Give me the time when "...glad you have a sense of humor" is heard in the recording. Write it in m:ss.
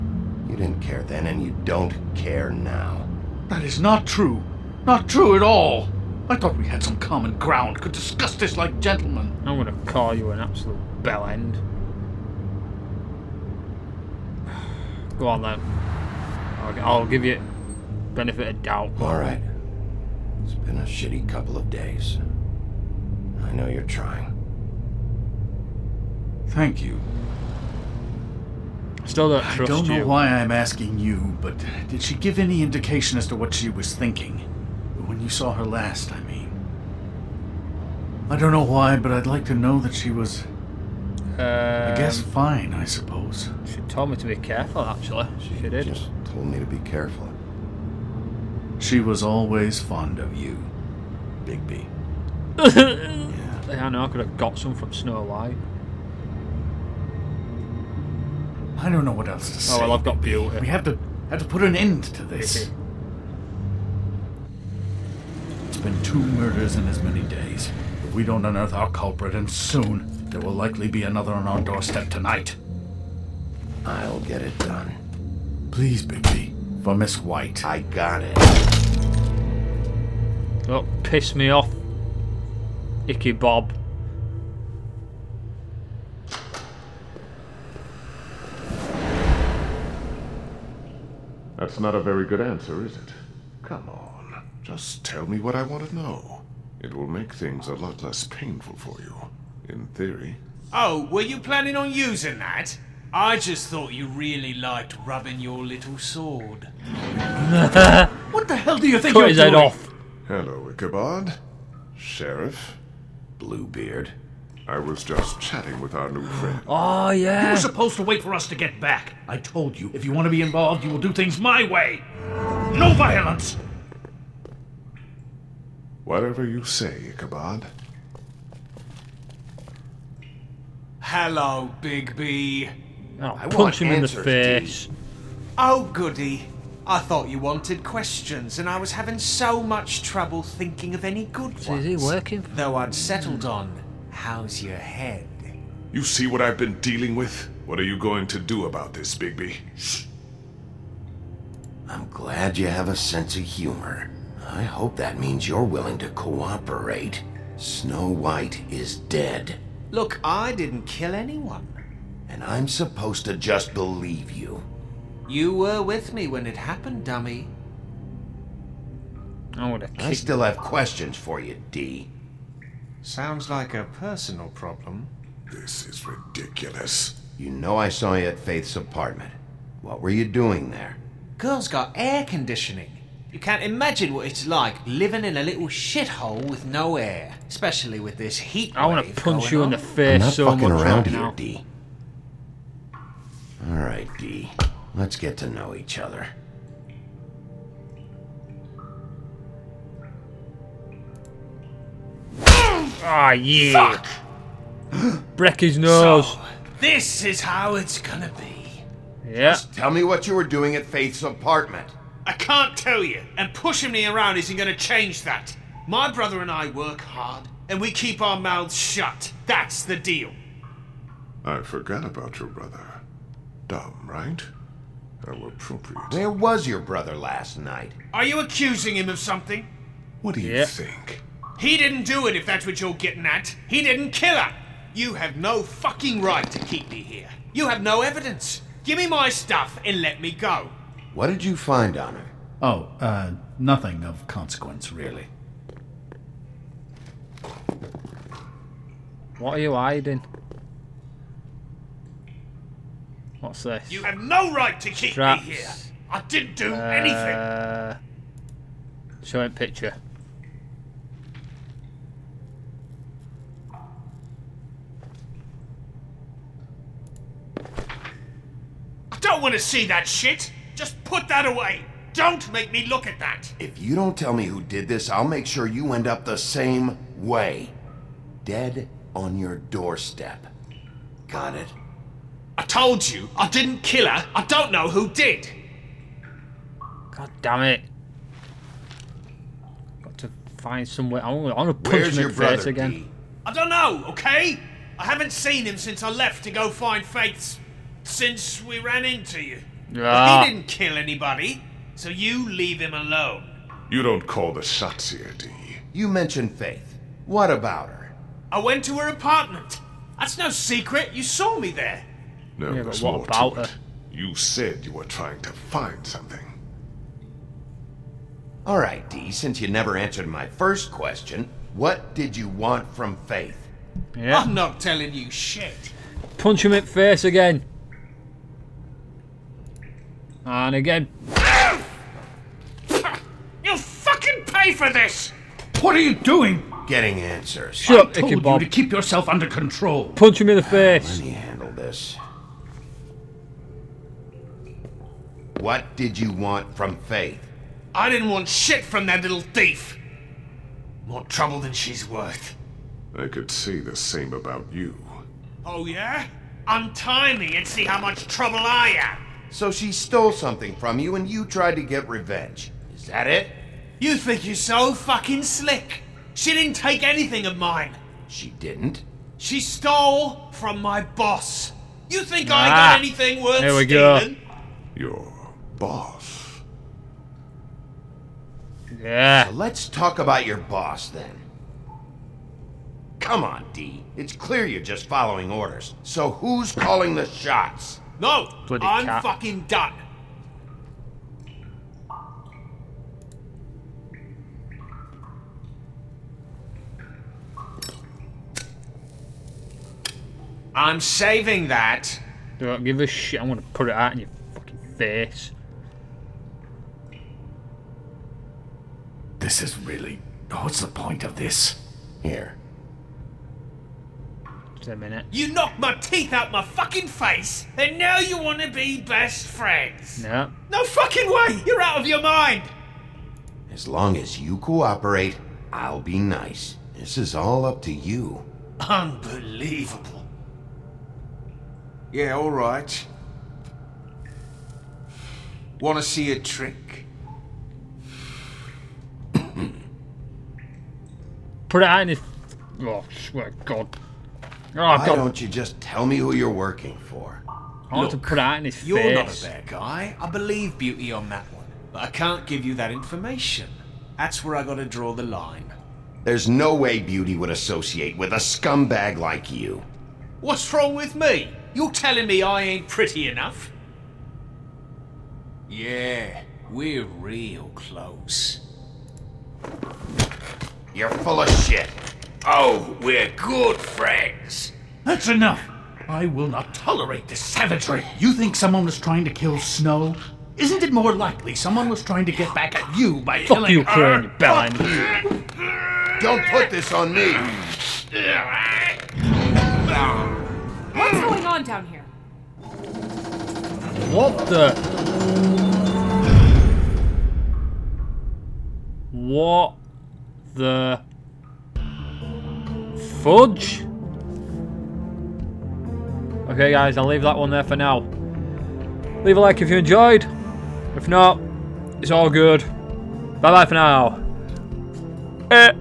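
2:32.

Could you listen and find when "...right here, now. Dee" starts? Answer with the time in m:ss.
3:10.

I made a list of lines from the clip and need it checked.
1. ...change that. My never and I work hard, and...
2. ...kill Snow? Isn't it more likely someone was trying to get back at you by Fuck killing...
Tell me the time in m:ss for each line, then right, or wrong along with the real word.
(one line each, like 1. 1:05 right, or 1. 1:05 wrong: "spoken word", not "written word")
1. 3:34 wrong: "brother", not "never"
2. 7:59 right.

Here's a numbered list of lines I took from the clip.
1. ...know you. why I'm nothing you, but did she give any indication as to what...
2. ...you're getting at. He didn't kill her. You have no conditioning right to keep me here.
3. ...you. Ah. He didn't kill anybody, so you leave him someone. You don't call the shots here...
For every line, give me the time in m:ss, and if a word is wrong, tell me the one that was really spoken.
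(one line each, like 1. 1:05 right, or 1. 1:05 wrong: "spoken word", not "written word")
1. 0:29 wrong: "asking", not "nothing"
2. 3:52 wrong: "fucking", not "conditioning"
3. 4:59 wrong: "alone", not "someone".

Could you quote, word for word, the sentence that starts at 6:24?
It's clear you're just following orders.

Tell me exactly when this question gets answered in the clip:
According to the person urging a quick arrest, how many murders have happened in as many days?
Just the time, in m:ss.
1:06.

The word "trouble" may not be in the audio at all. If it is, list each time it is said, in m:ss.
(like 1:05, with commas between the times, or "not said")
2:20, 5:51, 5:58.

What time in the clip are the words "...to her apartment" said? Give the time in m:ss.
5:08.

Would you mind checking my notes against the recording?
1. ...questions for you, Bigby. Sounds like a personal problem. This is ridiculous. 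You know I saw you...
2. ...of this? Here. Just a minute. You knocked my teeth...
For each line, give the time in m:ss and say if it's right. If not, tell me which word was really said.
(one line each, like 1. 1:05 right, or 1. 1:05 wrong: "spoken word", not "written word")
1. 2:50 wrong: "Dee", not "Bigby"
2. 6:51 right.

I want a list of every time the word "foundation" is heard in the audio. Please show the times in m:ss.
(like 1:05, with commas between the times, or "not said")
not said.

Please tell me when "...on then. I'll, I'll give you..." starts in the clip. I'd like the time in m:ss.
0:15.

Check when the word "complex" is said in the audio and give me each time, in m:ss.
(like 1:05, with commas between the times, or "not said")
not said.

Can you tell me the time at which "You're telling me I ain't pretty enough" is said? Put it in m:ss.
7:41.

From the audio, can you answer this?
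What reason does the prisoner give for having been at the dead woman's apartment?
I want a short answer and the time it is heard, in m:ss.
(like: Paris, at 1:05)
Air conditioning, at 3:01.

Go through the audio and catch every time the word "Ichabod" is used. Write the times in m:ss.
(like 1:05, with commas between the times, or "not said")
1:23, 1:50, 2:07, 5:38.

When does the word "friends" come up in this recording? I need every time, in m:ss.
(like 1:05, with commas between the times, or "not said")
1:56, 6:59, 7:53.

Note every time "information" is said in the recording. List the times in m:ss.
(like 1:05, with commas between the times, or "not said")
7:32.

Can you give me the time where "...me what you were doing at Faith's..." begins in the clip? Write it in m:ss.
3:29.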